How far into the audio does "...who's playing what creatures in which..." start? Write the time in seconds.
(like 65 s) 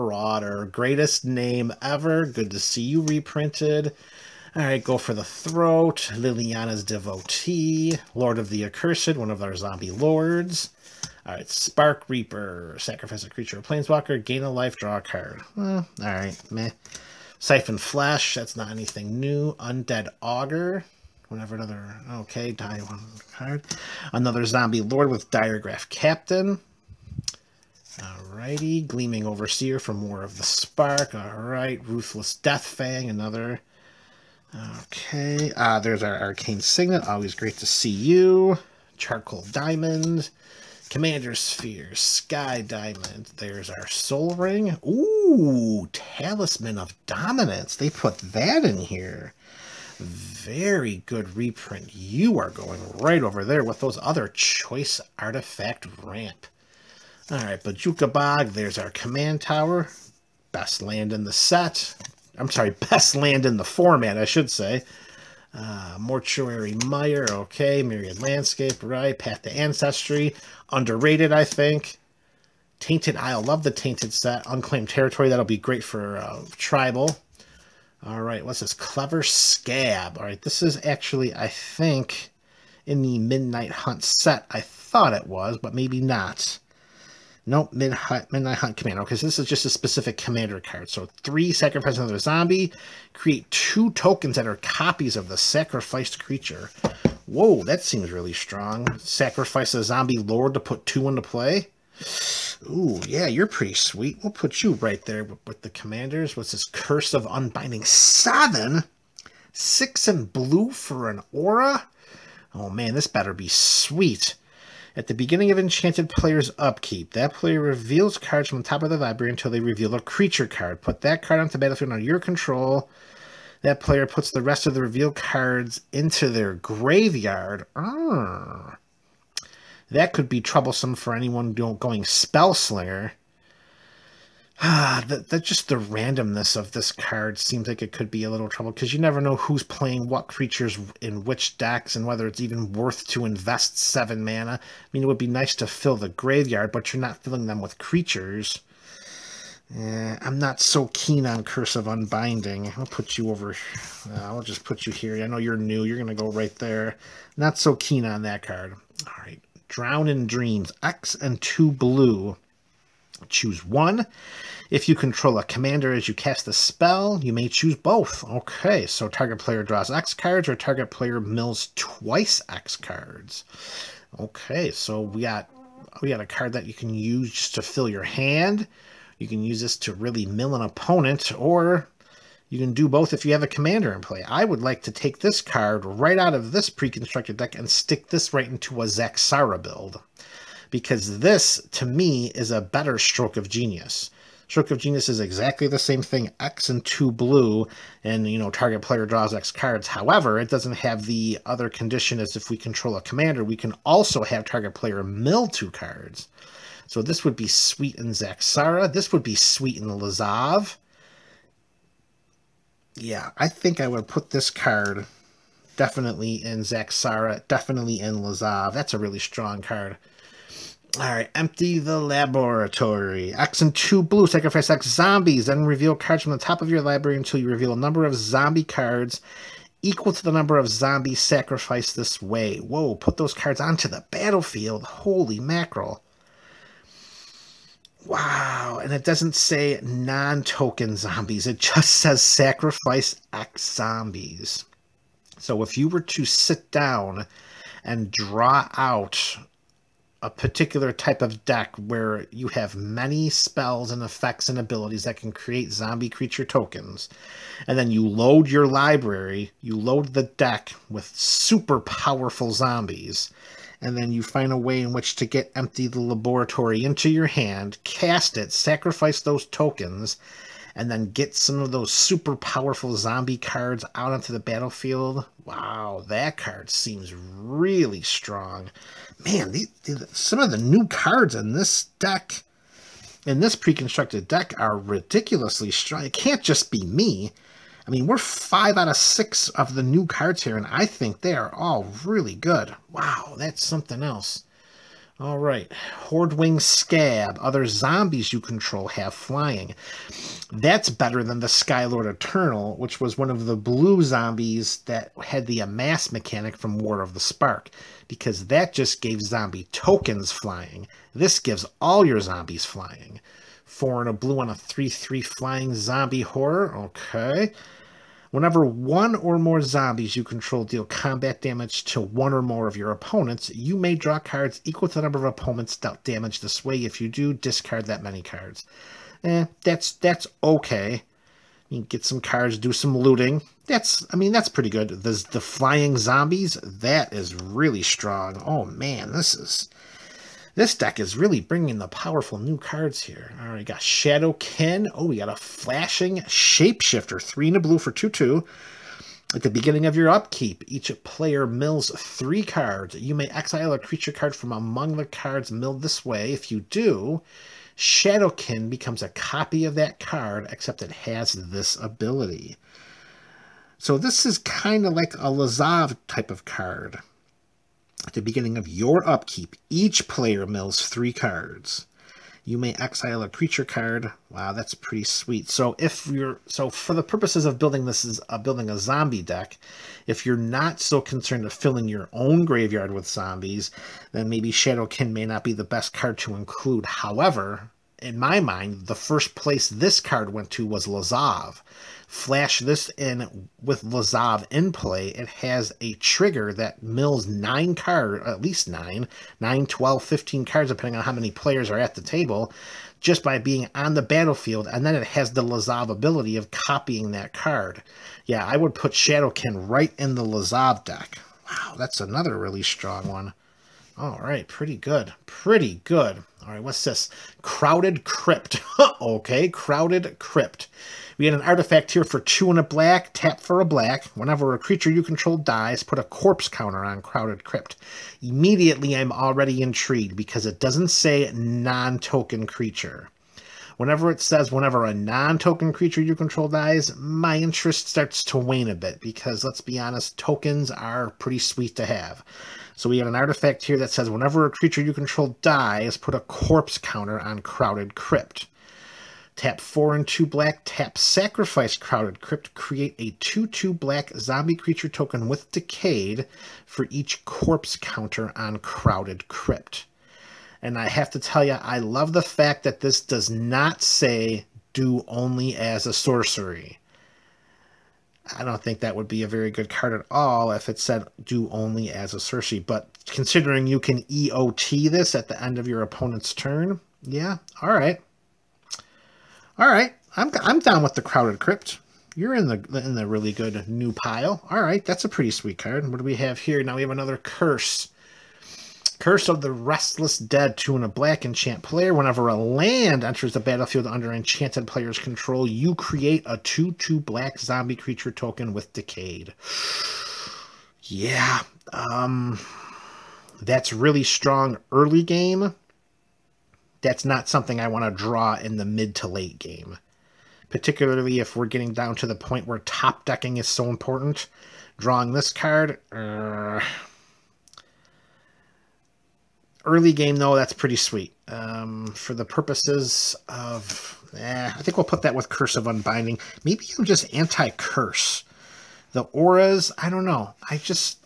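139 s.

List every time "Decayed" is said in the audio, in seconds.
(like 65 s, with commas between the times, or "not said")
455 s, 498 s.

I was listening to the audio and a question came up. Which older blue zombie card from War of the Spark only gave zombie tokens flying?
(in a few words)
Skylord Eternal.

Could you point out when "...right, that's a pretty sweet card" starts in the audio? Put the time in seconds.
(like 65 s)
484 s.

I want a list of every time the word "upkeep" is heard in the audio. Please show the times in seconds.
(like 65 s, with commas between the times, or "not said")
116 s, 350 s, 369 s.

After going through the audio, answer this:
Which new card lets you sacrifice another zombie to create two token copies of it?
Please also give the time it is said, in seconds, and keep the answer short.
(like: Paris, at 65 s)
Cleaver Skaab, at 78 s.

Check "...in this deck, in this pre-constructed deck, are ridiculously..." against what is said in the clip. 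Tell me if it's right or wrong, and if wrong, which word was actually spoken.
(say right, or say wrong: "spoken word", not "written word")
right.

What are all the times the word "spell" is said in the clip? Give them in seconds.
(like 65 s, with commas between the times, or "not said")
132 s, 166 s, 253 s.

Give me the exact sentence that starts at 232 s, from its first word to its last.
Whoa, put those cards onto the battlefield.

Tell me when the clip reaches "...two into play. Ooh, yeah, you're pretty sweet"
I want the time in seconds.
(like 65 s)
100 s.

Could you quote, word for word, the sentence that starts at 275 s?
Wow, that card seems really strong.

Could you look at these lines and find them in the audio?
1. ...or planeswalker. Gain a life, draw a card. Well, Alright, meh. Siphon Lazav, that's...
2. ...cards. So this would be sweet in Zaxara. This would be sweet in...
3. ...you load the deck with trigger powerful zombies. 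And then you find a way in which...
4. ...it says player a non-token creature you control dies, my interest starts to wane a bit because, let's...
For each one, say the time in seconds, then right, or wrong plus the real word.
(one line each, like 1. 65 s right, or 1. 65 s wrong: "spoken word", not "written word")
1. 13 s wrong: "Flesh", not "Lazav"
2. 205 s right
3. 259 s wrong: "super", not "trigger"
4. 434 s wrong: "whenever", not "player".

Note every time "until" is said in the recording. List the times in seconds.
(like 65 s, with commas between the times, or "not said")
119 s, 227 s.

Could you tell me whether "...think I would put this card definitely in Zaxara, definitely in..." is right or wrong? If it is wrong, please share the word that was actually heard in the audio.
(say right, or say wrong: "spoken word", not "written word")
right.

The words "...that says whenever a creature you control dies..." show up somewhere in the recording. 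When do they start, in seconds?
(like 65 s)
443 s.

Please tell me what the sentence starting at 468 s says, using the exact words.
I don't think that would be a very good card at all if it said do only as a sorcery.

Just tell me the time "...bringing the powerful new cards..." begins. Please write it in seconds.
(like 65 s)
341 s.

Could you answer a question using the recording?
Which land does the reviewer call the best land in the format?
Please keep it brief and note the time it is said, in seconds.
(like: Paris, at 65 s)
Command Tower, at 58 s.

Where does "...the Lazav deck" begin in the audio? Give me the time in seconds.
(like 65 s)
410 s.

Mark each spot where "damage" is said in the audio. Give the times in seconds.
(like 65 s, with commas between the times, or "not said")
321 s, 326 s.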